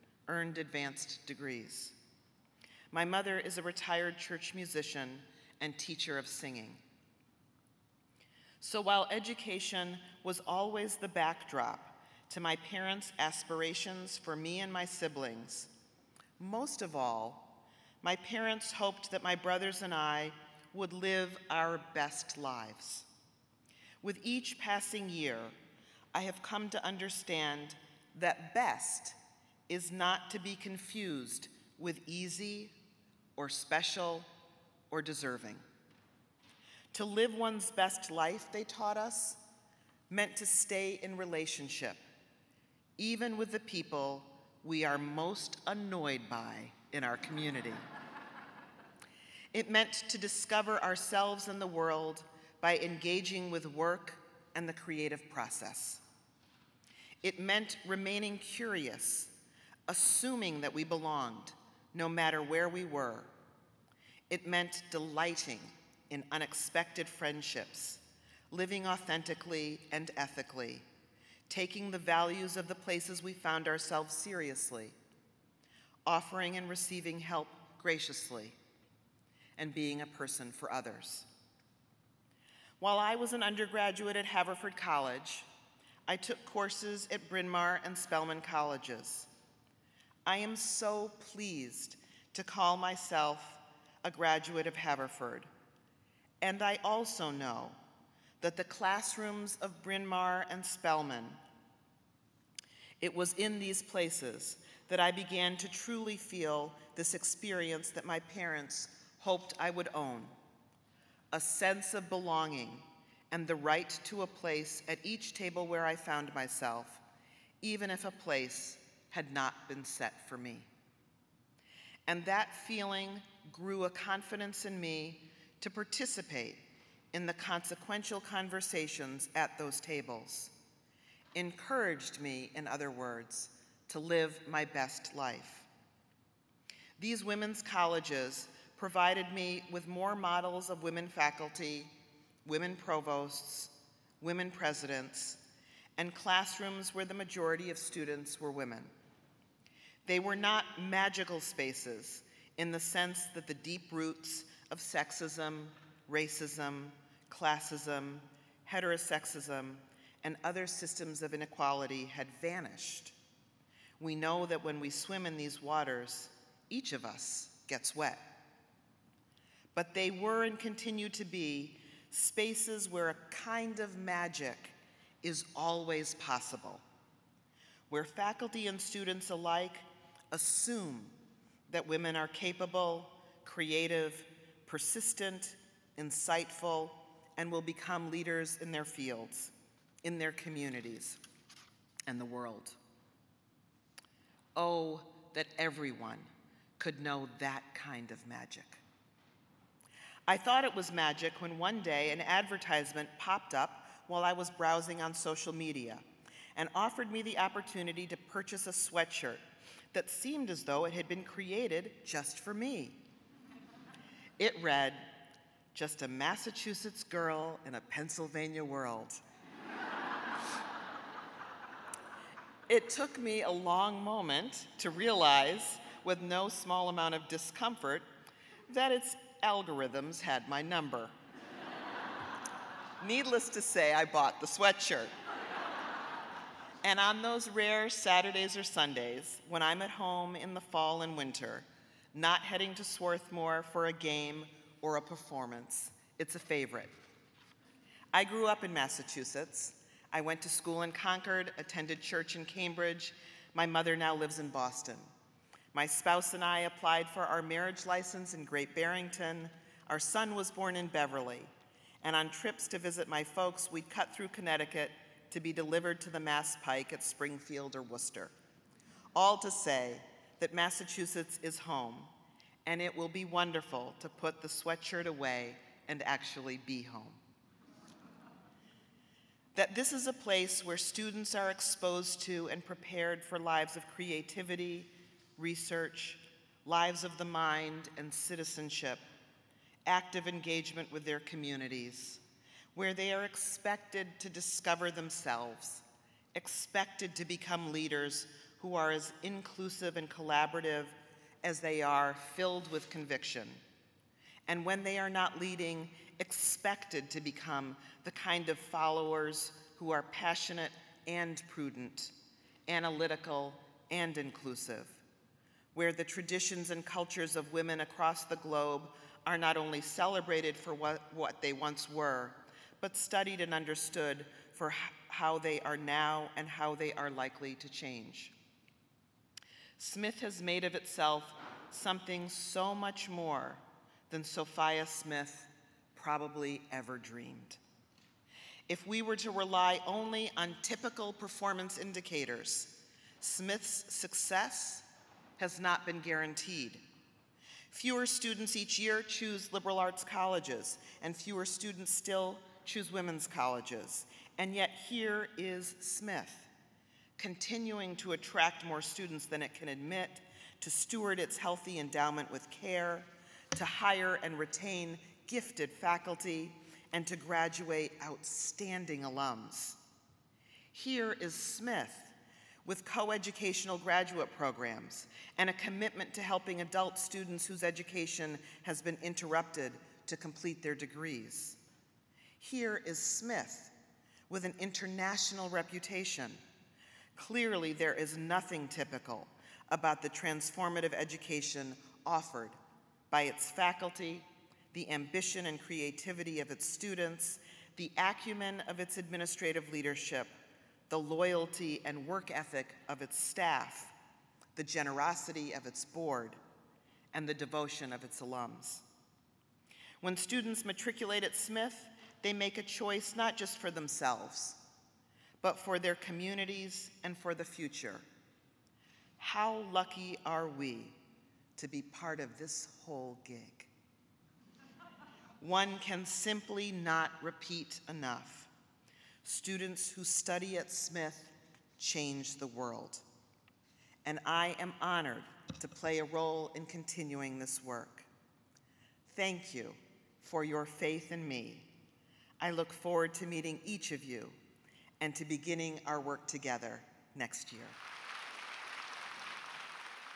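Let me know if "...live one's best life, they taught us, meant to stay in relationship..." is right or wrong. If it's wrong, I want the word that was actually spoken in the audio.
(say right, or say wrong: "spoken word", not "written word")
right.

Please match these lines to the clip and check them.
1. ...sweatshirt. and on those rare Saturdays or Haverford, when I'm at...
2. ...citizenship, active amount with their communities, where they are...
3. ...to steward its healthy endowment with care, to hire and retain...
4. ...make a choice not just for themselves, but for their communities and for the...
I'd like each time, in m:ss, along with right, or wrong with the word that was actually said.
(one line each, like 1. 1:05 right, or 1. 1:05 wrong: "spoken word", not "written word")
1. 3:54 wrong: "Sundays", not "Haverford"
2. 4:48 wrong: "engagement", not "amount"
3. 6:00 right
4. 6:52 right.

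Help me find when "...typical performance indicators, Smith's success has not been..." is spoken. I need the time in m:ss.
5:40.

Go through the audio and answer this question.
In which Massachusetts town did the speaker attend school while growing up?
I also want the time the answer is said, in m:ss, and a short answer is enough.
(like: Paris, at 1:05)
Concord, at 4:10.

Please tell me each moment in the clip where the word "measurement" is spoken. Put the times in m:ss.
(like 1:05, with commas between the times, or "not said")
not said.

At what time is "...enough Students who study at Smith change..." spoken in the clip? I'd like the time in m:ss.
7:07.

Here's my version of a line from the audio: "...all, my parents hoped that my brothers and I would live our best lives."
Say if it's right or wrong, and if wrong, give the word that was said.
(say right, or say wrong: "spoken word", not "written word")
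right.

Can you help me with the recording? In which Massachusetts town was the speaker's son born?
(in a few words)
Beverly.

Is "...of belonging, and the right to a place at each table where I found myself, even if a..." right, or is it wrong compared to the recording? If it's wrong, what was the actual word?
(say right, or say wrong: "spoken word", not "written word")
right.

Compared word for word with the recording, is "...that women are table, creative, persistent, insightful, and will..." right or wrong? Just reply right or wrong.
wrong.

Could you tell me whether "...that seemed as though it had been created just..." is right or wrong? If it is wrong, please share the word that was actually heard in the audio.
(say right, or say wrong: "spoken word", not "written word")
right.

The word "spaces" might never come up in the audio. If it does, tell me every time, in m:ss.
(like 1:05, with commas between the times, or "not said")
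2:31, 2:52.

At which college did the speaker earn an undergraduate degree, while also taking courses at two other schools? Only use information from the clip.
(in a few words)
Haverford College.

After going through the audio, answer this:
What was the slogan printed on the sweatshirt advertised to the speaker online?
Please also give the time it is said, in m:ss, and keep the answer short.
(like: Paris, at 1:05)
Just a Massachusetts girl in a Pennsylvania world, at 3:35.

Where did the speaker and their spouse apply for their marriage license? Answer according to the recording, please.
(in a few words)
Great Barrington.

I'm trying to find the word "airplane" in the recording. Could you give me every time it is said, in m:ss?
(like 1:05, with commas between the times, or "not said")
not said.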